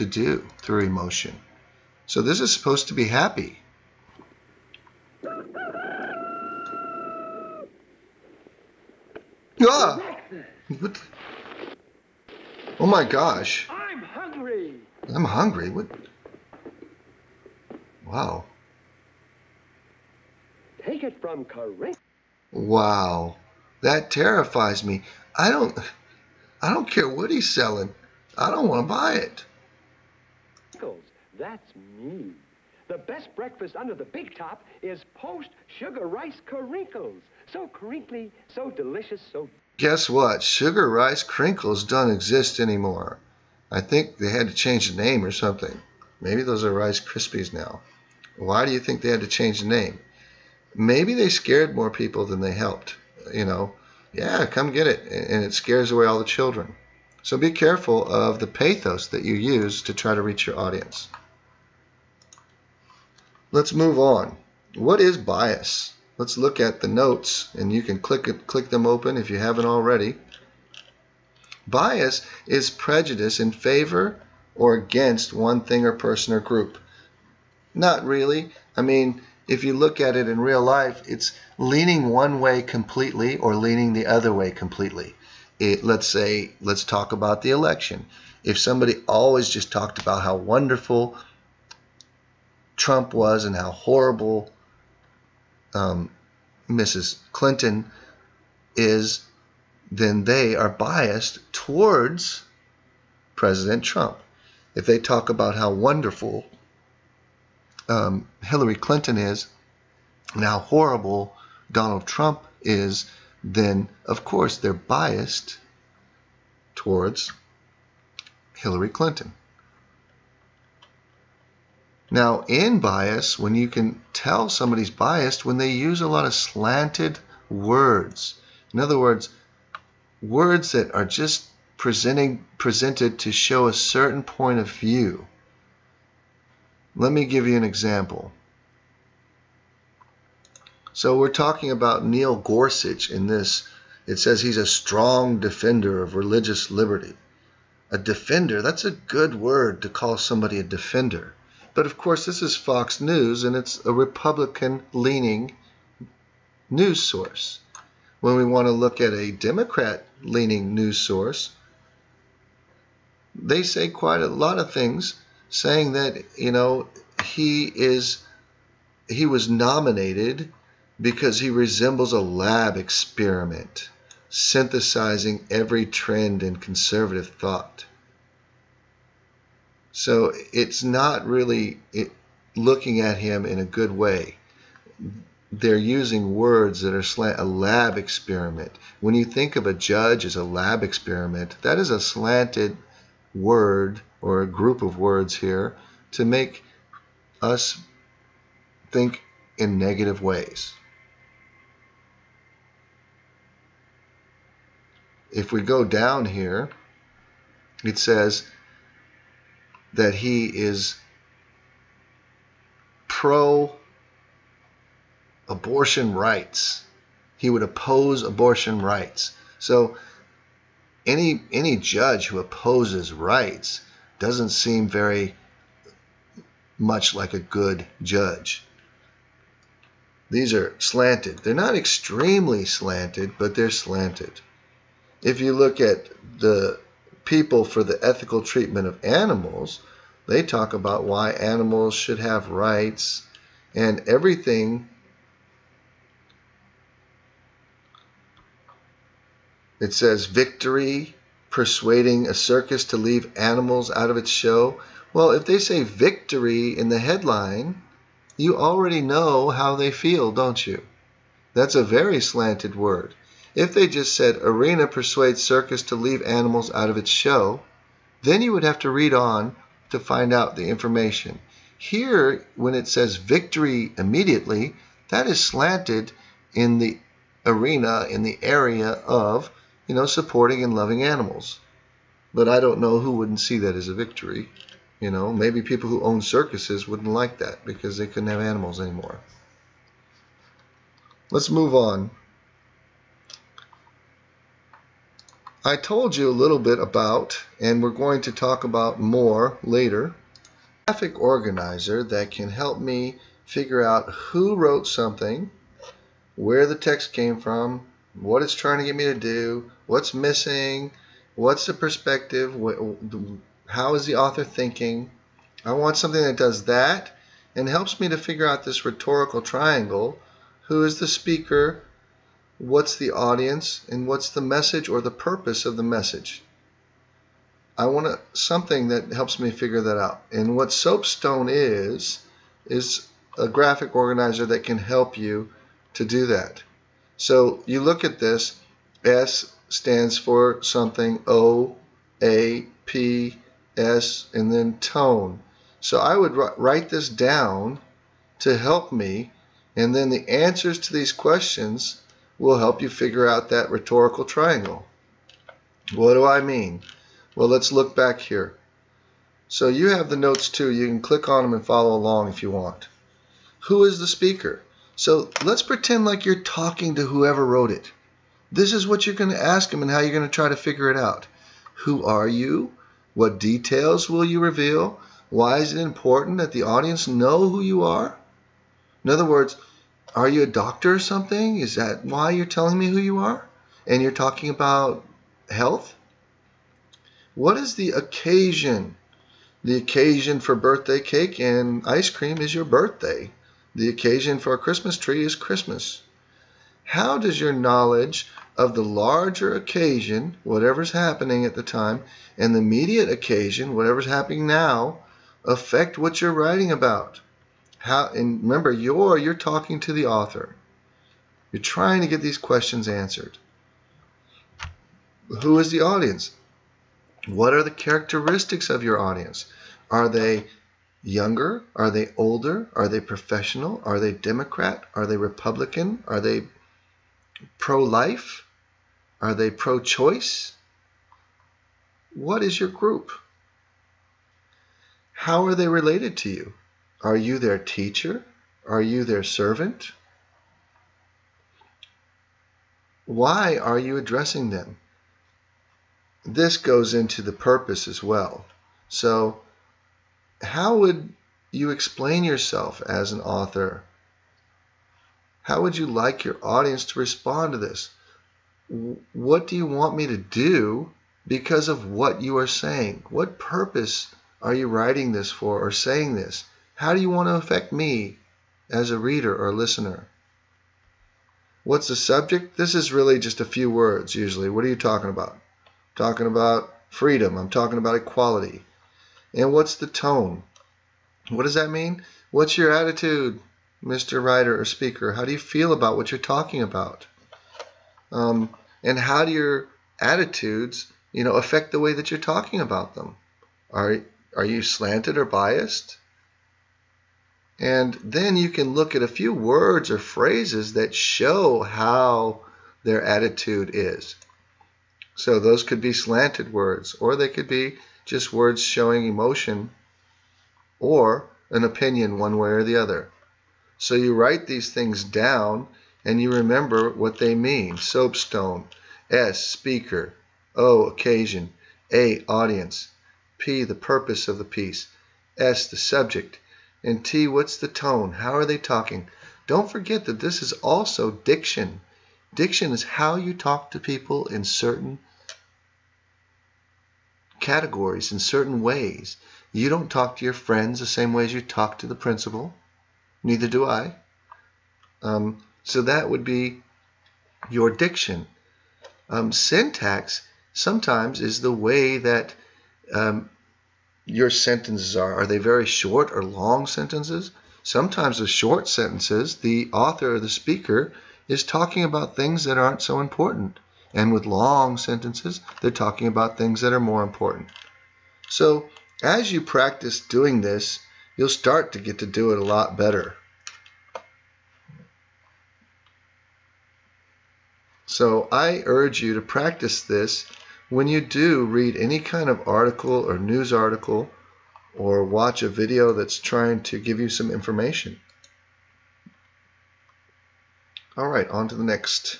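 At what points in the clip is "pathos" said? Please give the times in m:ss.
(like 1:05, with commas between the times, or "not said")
0:58.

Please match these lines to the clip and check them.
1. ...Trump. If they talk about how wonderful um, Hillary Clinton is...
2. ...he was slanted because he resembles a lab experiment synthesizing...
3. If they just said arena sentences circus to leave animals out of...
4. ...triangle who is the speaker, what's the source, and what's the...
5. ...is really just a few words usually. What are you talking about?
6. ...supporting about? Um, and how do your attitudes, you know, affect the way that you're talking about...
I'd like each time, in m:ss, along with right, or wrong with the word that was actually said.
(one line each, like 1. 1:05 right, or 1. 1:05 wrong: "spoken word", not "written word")
1. 1:43 right
2. 2:49 wrong: "nominated", not "slanted"
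3. 4:23 wrong: "persuades", not "sentences"
4. 5:19 wrong: "audience", not "source"
5. 7:52 right
6. 8:06 wrong: "talking", not "supporting".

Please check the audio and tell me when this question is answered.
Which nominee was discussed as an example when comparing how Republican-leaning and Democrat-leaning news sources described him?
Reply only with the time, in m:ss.
2:22.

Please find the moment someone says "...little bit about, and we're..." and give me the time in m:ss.
4:56.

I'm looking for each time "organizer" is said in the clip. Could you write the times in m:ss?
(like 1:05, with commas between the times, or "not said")
5:01, 5:33.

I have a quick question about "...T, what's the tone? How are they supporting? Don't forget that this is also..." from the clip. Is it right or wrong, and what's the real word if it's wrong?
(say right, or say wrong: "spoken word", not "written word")
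wrong: "talking", not "supporting".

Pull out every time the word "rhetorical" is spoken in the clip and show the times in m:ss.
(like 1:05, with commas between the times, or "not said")
5:18, 5:53.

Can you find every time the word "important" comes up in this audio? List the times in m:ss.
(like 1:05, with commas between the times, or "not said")
6:15, 9:23, 9:27.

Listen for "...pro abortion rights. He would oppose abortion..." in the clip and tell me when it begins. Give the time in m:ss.
3:33.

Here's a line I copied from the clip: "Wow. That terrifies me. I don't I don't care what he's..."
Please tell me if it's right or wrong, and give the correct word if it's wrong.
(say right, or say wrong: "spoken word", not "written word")
right.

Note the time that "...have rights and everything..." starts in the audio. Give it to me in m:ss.
4:02.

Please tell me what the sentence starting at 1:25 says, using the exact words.
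It, let's say, let's talk about the election.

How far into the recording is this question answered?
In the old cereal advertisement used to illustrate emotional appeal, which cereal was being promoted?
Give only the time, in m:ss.
0:35.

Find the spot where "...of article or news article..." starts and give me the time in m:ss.
9:42.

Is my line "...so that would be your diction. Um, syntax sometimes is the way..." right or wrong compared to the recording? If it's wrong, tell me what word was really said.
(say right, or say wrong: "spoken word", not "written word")
right.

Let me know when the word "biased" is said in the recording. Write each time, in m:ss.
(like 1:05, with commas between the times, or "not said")
1:40, 1:54, 2:04, 8:15.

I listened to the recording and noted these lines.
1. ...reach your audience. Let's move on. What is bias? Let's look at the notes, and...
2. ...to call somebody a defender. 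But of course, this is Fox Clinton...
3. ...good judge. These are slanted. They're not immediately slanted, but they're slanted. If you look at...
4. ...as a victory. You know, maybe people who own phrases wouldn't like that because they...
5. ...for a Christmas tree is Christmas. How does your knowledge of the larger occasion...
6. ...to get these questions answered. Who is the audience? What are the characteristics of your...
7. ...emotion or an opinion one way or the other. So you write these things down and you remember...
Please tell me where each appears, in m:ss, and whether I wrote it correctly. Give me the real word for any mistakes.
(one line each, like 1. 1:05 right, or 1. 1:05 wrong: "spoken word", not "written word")
1. 1:00 right
2. 2:29 wrong: "News", not "Clinton"
3. 3:47 wrong: "extremely", not "immediately"
4. 4:43 wrong: "circuses", not "phrases"
5. 6:34 right
6. 6:52 right
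7. 8:29 right.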